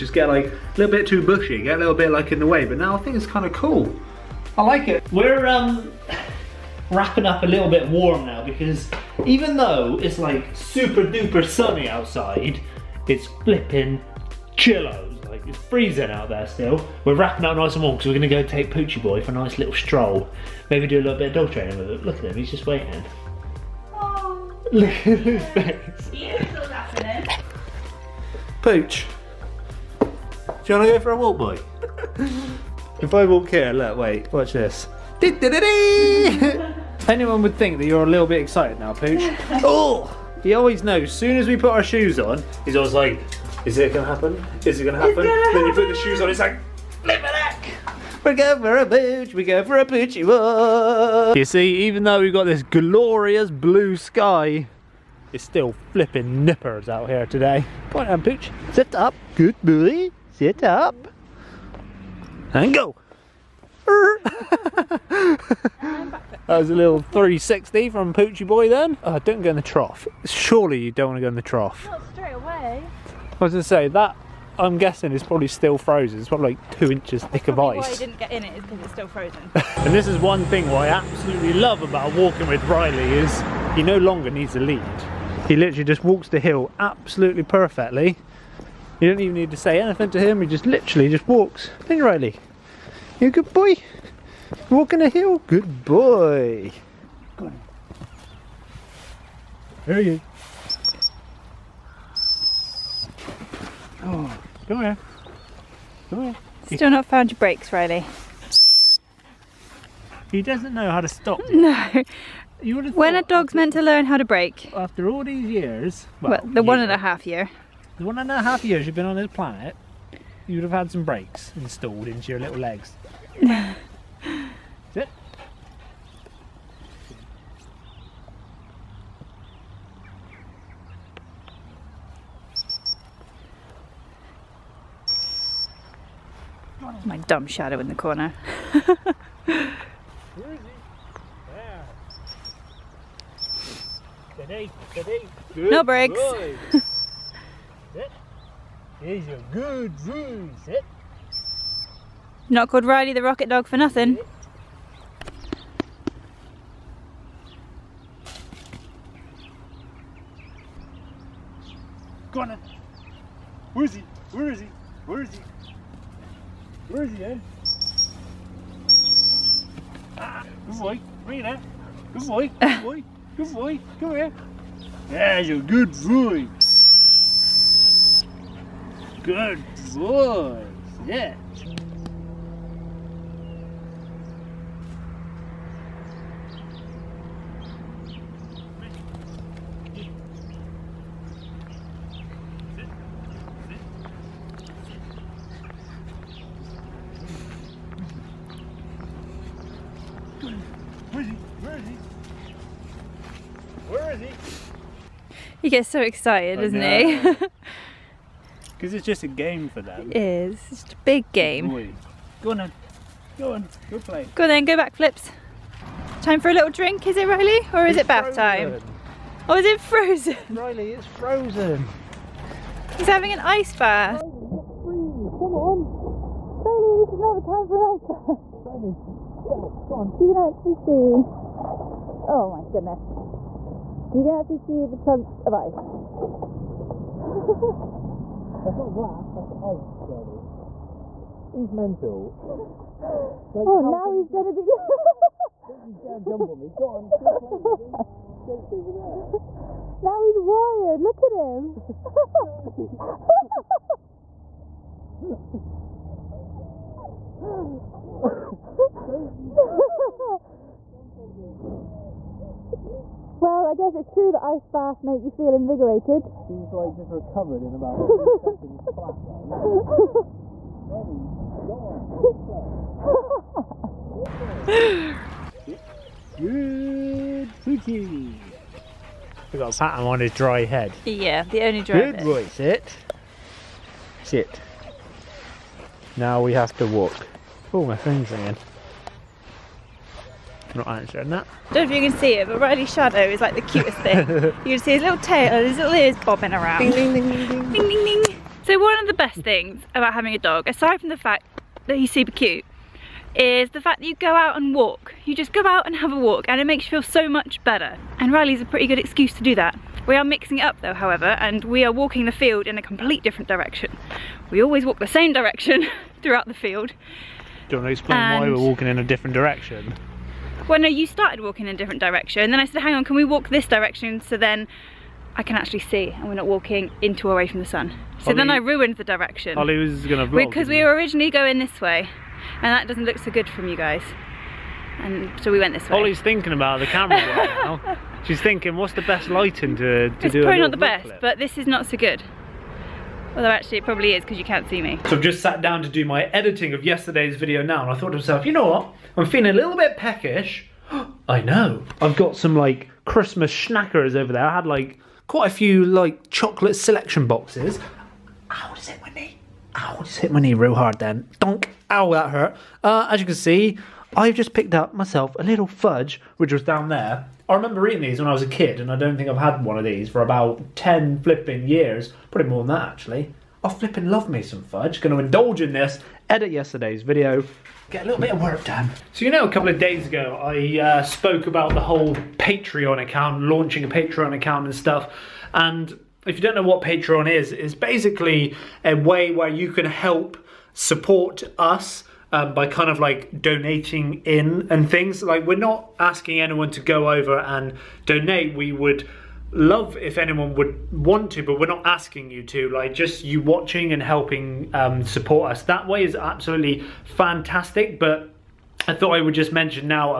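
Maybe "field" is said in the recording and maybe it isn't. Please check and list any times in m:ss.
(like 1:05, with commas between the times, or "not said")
5:12, 5:16.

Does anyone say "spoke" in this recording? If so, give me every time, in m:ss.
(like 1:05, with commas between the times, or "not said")
6:21.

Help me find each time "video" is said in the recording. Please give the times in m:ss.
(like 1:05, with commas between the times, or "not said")
5:47, 6:17.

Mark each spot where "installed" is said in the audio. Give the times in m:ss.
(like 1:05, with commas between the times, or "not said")
2:01.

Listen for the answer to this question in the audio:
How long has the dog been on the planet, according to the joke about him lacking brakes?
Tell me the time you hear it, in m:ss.
1:58.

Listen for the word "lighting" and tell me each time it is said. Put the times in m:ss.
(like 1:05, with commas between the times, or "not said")
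5:39.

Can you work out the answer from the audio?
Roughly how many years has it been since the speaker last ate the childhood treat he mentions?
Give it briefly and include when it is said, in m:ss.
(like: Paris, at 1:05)
10, at 6:10.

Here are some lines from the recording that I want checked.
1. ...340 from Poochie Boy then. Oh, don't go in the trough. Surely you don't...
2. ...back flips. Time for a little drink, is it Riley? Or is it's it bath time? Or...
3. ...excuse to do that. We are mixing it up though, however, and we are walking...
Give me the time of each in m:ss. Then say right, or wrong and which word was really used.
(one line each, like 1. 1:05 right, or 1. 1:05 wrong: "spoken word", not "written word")
1. 1:06 wrong: "360", not "340"
2. 3:34 right
3. 5:08 right.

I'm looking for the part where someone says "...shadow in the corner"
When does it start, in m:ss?
2:17.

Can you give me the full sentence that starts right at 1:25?
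He literally just walks the hill absolutely perfectly you don't even need to say anything to him, he just literally just walks.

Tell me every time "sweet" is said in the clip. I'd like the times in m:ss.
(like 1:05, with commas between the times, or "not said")
not said.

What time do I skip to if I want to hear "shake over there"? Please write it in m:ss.
4:08.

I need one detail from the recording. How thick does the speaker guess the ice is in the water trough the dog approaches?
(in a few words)
2 inches.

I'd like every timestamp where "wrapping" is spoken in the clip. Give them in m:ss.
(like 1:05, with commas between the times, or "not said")
0:06, 0:17.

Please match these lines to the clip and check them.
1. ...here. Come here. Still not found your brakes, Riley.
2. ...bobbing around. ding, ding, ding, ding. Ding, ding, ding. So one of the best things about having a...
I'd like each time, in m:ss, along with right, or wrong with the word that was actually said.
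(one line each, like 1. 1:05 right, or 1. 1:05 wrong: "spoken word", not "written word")
1. 1:44 right
2. 4:56 right.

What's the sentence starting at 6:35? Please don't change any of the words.
Like we're not asking anyone to go over and donate.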